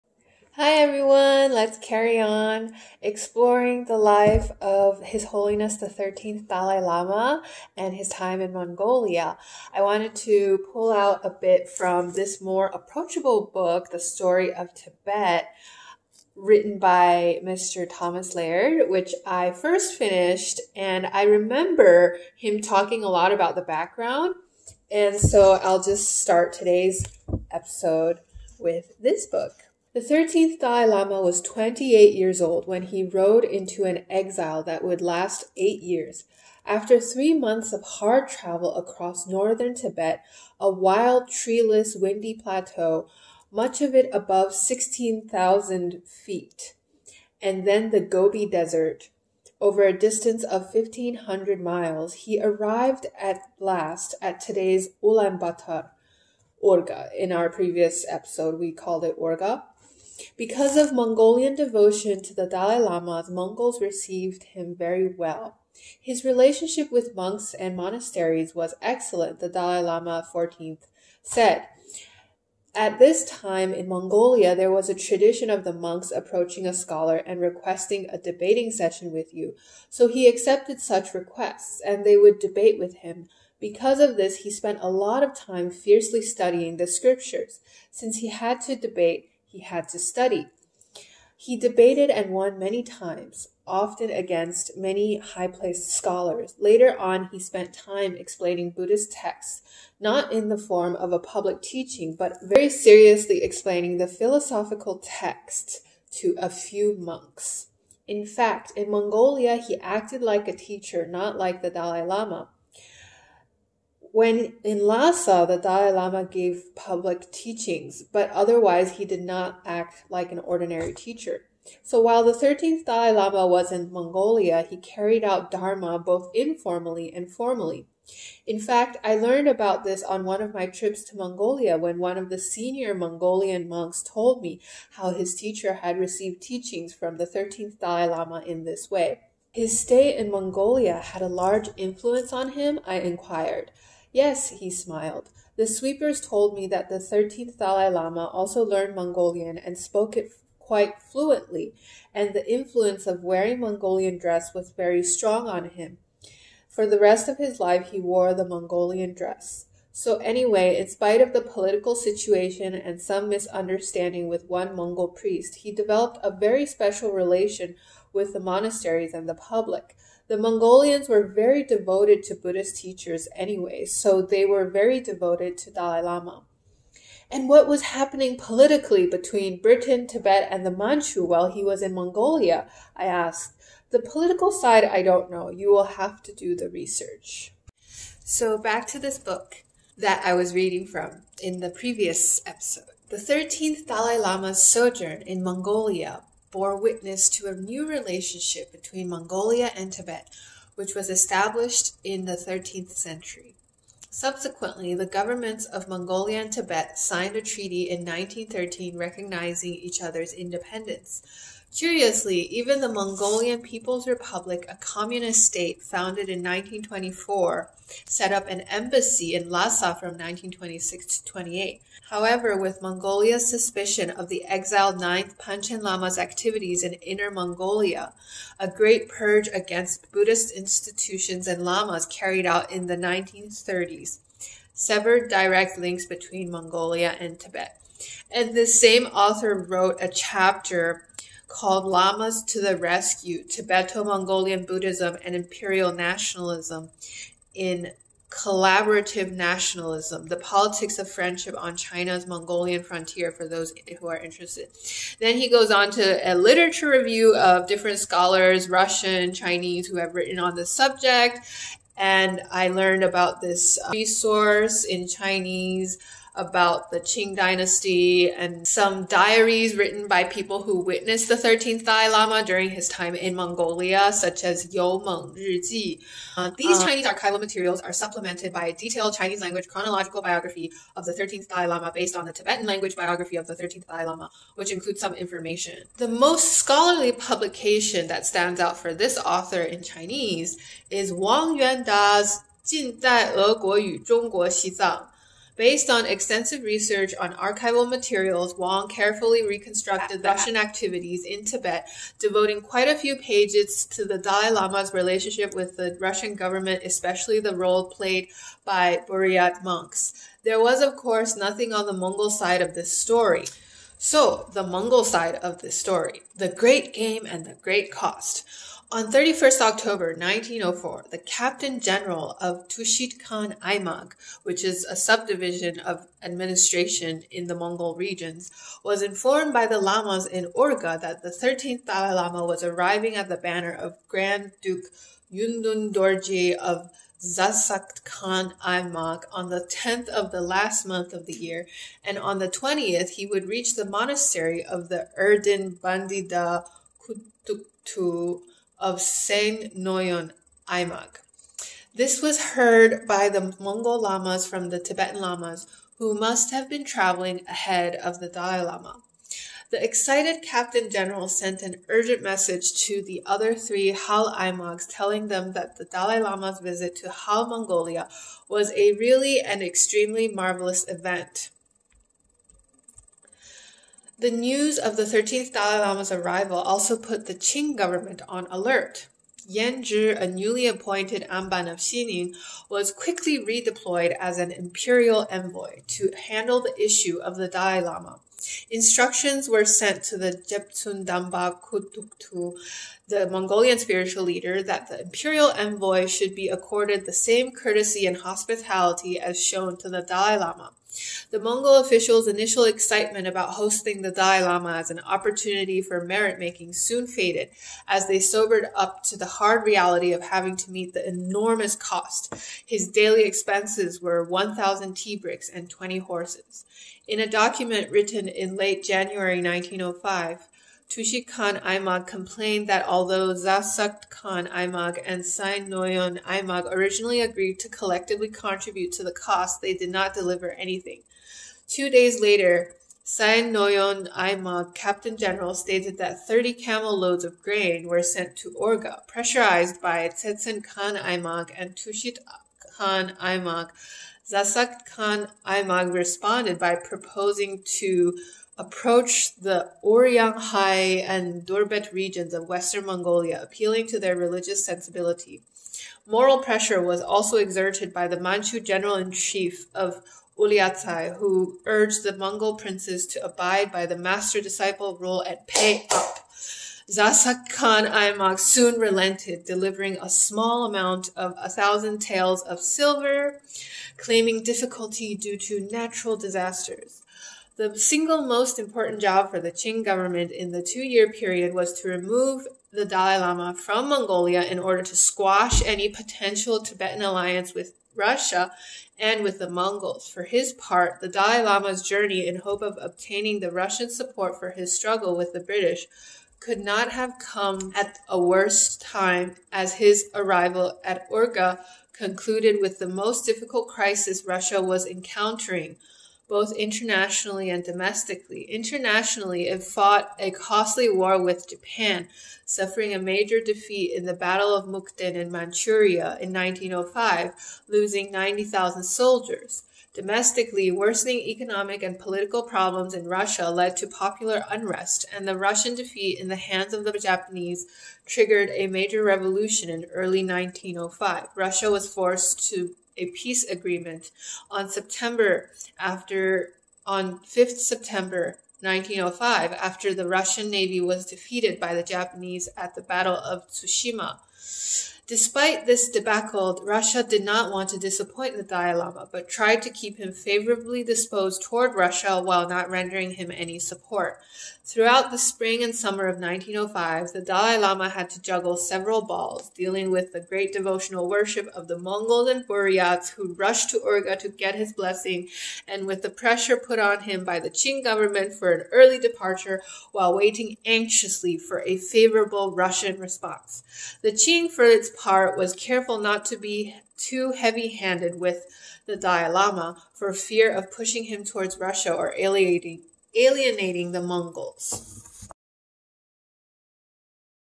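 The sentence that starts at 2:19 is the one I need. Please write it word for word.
His stay in Mongolia had a large influence on him, I inquired.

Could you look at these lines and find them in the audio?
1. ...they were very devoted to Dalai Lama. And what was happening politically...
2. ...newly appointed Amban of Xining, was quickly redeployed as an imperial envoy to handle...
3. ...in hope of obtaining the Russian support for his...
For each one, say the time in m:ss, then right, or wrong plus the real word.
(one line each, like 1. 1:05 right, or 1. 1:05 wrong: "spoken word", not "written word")
1. 2:54 right
2. 6:20 right
3. 8:12 right.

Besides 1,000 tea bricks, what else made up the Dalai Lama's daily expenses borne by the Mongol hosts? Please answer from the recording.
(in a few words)
20 horses.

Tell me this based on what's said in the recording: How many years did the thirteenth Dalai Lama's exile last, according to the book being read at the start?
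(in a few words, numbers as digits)
8 years.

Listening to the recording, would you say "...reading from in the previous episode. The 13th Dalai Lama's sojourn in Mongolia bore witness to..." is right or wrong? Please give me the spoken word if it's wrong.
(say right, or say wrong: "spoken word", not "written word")
right.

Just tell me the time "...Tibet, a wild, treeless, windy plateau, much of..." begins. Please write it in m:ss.
0:39.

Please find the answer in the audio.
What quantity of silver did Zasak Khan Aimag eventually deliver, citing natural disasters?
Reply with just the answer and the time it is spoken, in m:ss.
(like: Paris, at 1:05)
1,000 taels, at 7:51.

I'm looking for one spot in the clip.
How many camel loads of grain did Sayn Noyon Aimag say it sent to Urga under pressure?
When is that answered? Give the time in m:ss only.
7:16.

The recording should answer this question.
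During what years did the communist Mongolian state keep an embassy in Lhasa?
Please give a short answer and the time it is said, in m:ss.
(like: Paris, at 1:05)
1926 to 1928, at 3:40.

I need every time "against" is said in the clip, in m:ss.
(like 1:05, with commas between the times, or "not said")
1:34, 3:49.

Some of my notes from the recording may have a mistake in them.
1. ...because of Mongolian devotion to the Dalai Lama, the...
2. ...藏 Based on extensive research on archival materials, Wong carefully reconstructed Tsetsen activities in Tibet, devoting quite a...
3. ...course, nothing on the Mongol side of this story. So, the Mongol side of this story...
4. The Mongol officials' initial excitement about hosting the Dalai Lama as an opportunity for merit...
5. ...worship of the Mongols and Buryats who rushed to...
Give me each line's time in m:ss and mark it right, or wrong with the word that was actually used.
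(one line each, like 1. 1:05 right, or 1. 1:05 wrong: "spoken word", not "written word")
1. 1:00 right
2. 4:54 wrong: "Russian", not "Tsetsen"
3. 5:10 right
4. 6:41 right
5. 9:21 right.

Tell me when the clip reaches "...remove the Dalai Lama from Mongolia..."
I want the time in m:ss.
8:01.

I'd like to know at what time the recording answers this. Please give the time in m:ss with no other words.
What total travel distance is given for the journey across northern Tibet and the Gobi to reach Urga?
0:50.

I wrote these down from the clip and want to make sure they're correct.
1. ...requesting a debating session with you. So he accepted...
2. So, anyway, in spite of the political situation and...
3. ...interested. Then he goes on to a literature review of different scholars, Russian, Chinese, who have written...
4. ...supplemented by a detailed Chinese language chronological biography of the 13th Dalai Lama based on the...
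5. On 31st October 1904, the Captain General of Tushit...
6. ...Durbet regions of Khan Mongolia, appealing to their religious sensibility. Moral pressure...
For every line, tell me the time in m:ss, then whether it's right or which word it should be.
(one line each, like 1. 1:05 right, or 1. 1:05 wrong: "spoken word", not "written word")
1. 1:17 right
2. 2:39 right
3. 4:14 right
4. 4:37 right
5. 5:18 right
6. 7:31 wrong: "Western", not "Khan".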